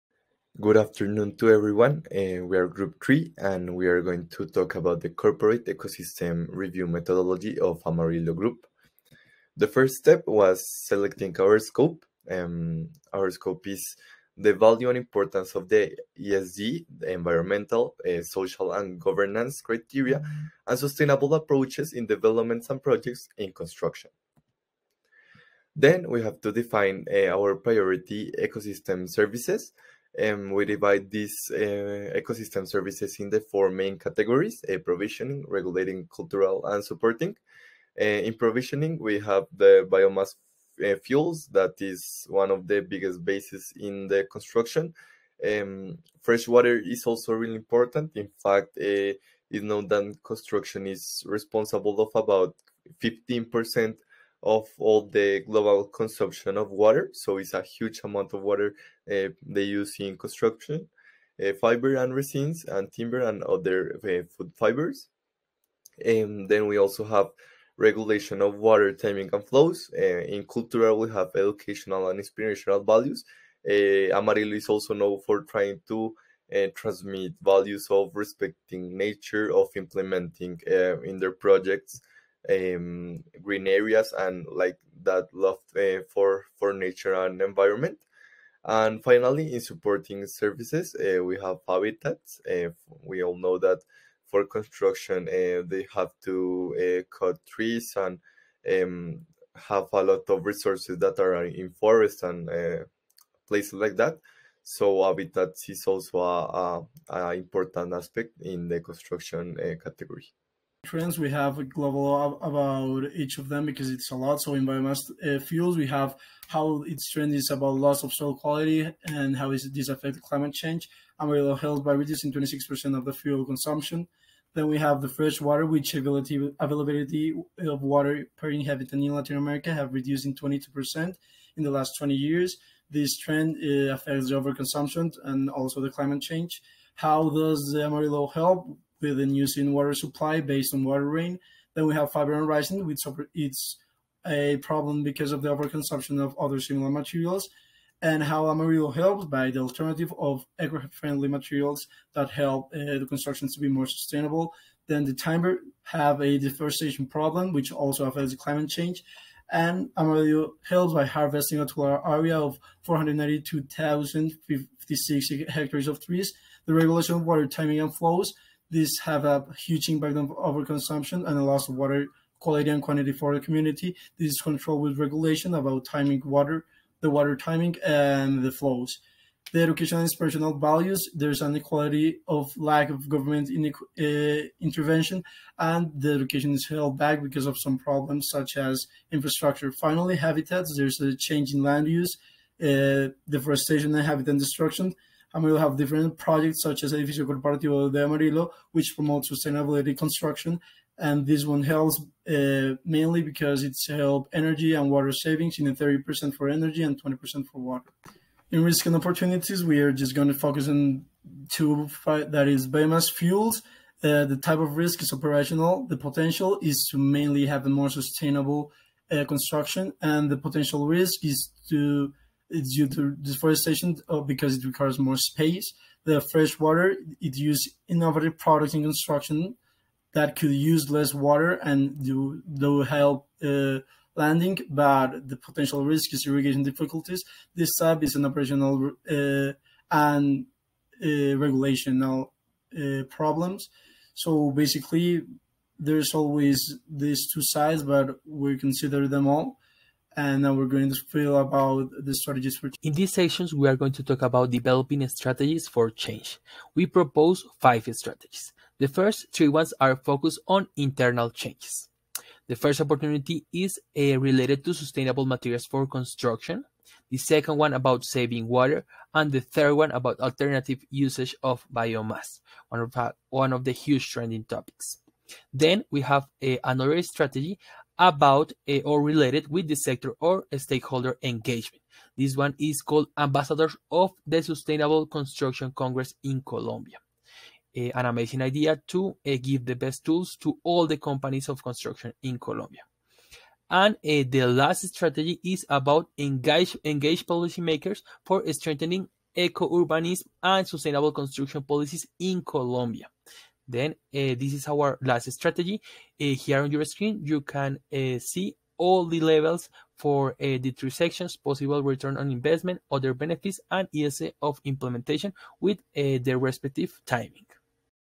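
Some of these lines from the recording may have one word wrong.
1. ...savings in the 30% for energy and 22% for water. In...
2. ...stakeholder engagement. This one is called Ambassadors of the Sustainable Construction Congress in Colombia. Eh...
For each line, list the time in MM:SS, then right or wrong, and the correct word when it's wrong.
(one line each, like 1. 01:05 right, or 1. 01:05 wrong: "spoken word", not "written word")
1. 03:25 wrong: "20", not "22"
2. 04:40 right.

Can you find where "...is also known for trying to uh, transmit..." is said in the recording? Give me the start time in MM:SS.
01:14.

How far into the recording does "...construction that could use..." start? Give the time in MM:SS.
03:48.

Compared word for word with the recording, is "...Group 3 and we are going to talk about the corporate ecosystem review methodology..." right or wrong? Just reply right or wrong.
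right.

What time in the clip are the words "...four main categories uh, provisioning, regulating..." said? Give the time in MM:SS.
00:33.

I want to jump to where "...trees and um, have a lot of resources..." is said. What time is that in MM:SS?
01:37.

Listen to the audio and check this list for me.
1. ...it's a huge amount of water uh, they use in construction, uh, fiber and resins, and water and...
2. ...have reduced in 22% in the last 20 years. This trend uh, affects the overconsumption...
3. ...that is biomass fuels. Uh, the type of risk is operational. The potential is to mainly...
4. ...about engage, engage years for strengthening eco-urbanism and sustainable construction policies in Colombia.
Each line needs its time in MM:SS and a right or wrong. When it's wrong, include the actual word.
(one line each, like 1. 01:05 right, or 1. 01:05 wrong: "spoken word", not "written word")
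1. 00:57 wrong: "timber", not "water"
2. 02:09 right
3. 03:32 right
4. 04:55 wrong: "policymakers", not "years".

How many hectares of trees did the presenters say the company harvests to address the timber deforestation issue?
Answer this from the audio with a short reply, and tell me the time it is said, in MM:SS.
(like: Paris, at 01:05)
492,056 hectares, at 02:42.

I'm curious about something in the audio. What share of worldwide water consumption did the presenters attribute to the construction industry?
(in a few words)
15%.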